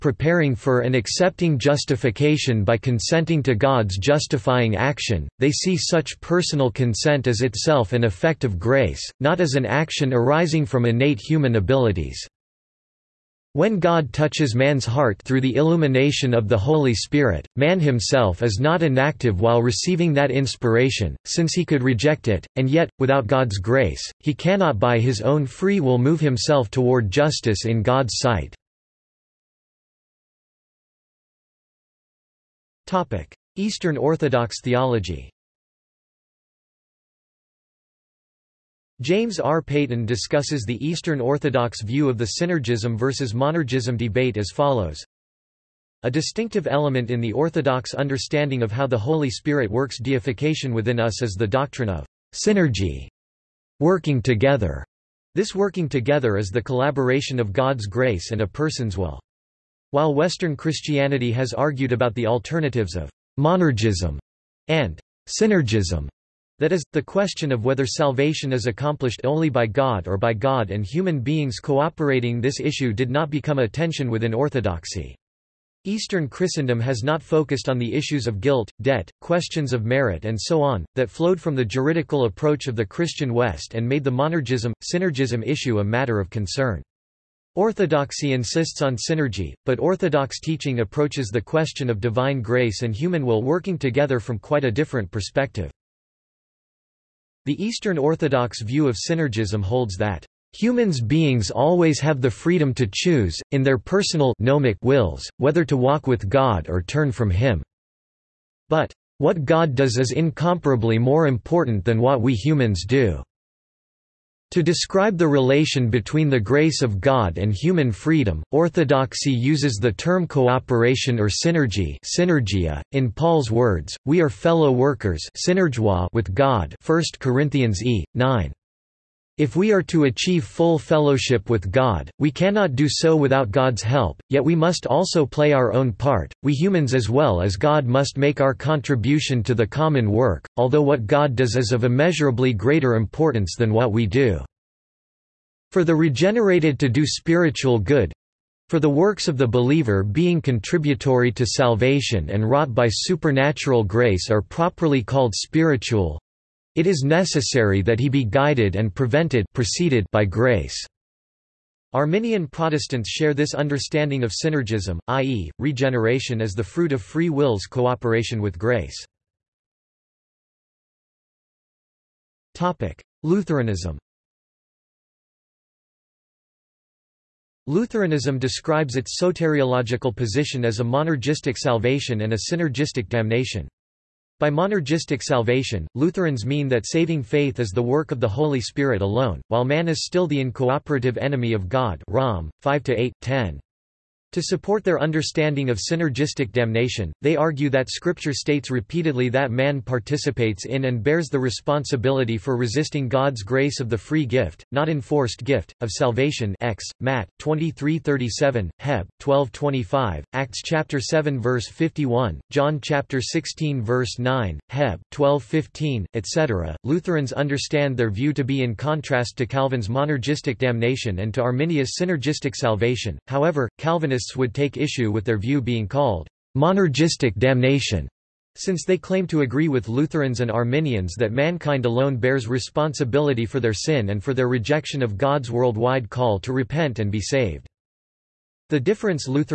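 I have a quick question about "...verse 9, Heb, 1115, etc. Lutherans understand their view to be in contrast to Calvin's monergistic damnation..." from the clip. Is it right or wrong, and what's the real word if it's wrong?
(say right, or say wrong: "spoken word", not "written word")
wrong: "1215", not "1115".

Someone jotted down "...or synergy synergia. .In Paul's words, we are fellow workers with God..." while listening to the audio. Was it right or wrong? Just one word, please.
right.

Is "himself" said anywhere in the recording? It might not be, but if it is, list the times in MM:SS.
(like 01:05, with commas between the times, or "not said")
00:17, 00:26.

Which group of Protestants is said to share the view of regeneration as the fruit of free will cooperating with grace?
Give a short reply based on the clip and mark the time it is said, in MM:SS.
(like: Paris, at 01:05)
Arminian Protestants, at 02:41.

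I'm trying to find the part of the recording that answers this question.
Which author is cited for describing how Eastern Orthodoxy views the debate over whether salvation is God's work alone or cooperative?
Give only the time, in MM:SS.
00:39.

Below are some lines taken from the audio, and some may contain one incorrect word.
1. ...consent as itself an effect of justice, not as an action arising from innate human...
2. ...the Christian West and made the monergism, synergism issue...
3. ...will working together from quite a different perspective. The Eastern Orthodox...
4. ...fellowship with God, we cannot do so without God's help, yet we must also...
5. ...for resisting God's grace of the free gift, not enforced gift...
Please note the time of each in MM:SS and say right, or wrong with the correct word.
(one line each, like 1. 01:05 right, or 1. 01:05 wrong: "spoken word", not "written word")
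1. 00:06 wrong: "grace", not "justice"
2. 01:22 right
3. 01:33 right
4. 02:10 right
5. 03:22 right.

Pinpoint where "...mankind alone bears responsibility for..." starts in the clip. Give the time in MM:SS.
03:51.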